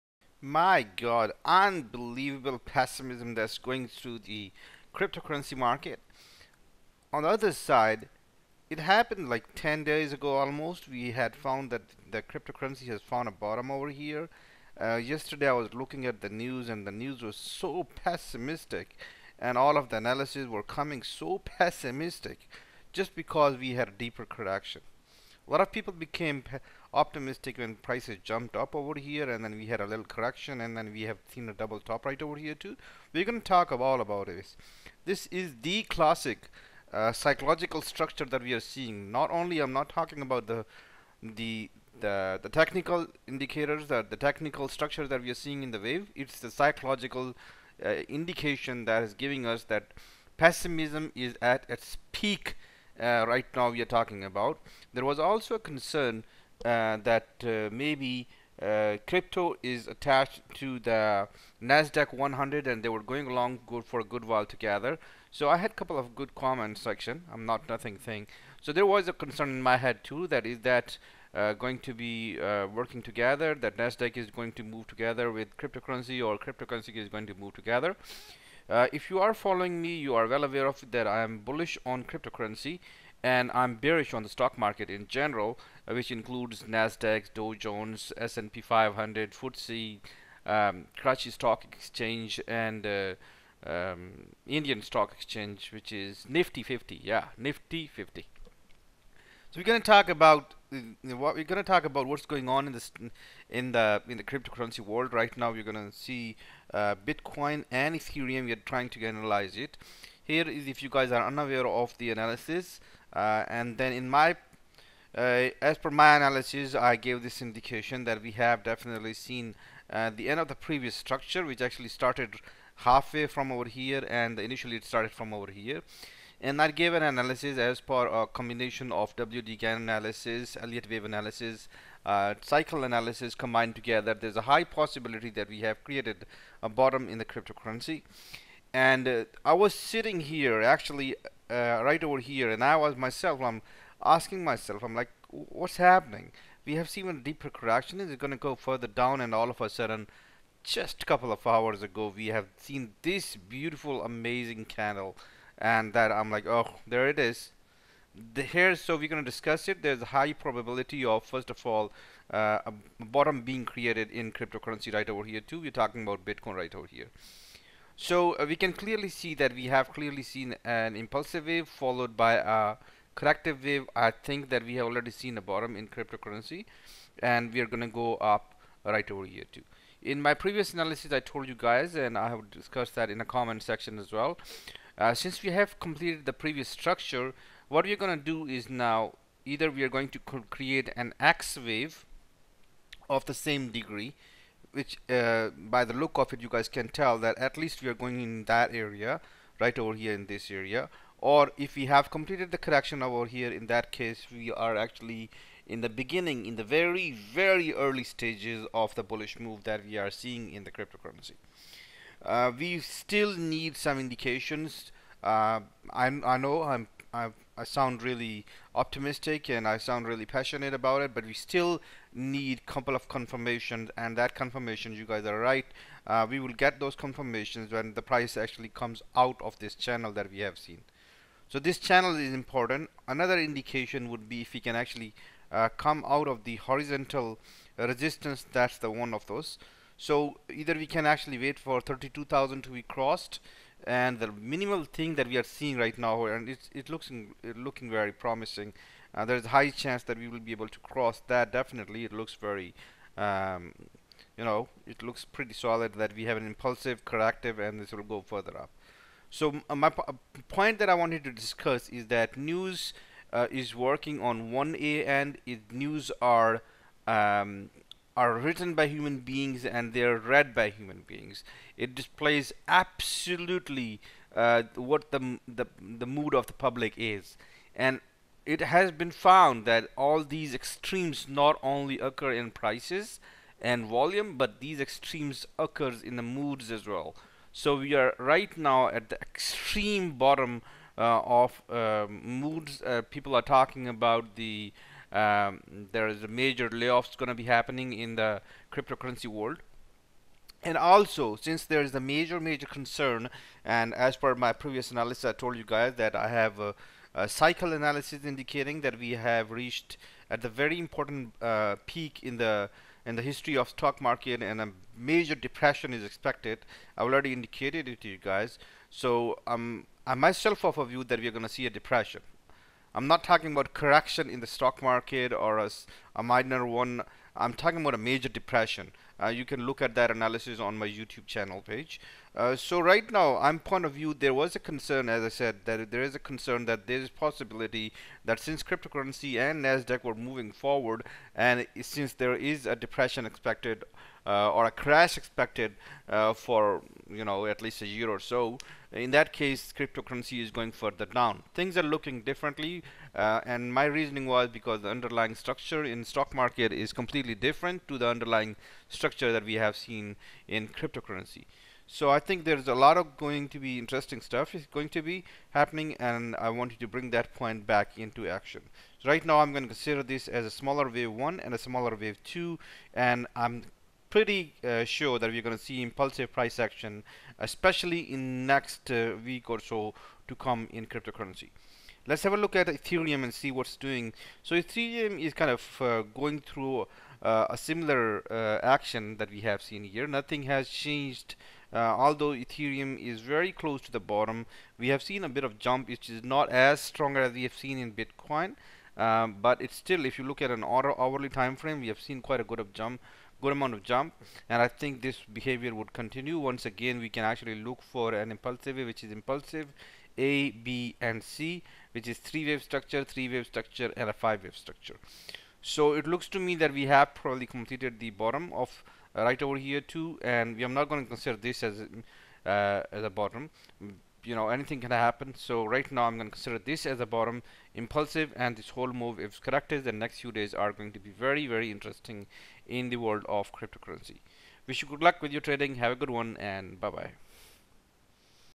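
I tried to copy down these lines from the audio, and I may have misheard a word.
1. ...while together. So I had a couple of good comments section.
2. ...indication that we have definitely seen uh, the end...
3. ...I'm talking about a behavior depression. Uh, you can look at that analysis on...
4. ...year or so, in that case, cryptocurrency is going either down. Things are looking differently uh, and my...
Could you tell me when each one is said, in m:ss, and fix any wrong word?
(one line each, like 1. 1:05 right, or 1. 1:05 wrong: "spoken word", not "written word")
1. 1:04 right
2. 1:57 right
3. 5:27 wrong: "major", not "behavior"
4. 5:47 wrong: "further", not "either".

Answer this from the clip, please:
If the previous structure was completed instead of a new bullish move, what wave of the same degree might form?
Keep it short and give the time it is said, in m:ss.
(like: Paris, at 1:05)
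X wave, at 3:11.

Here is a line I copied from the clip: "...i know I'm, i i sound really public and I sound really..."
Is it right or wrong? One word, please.
wrong.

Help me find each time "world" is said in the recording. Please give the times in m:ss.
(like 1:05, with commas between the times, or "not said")
1:44, 4:59, 7:12.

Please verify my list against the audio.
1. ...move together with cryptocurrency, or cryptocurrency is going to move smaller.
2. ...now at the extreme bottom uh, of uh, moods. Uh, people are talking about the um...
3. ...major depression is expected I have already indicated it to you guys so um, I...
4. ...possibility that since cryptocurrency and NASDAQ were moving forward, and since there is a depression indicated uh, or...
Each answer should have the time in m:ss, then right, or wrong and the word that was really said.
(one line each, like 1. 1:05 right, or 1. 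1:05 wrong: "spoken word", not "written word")
1. 1:14 wrong: "together", not "smaller"
2. 4:48 right
3. 5:14 right
4. 5:37 wrong: "expected", not "indicated".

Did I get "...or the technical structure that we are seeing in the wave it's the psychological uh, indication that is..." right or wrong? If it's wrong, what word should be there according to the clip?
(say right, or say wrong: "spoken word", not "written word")
right.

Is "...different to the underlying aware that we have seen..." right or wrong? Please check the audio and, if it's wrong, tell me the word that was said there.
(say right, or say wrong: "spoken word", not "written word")
wrong: "structure", not "aware".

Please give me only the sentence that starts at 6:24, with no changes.
So Ethereum is kind of uh, going through uh, a similar uh, action that we have seen here.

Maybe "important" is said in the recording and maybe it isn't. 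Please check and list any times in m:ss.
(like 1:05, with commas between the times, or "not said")
3:52, 5:10.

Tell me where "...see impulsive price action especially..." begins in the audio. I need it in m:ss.
6:15.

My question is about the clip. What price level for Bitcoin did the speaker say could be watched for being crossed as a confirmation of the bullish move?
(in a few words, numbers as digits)
32,000.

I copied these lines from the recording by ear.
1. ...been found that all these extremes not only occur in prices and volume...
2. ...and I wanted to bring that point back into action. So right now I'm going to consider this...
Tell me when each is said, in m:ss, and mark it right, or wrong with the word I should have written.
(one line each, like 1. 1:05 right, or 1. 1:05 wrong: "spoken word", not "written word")
1. 4:38 right
2. 6:05 right.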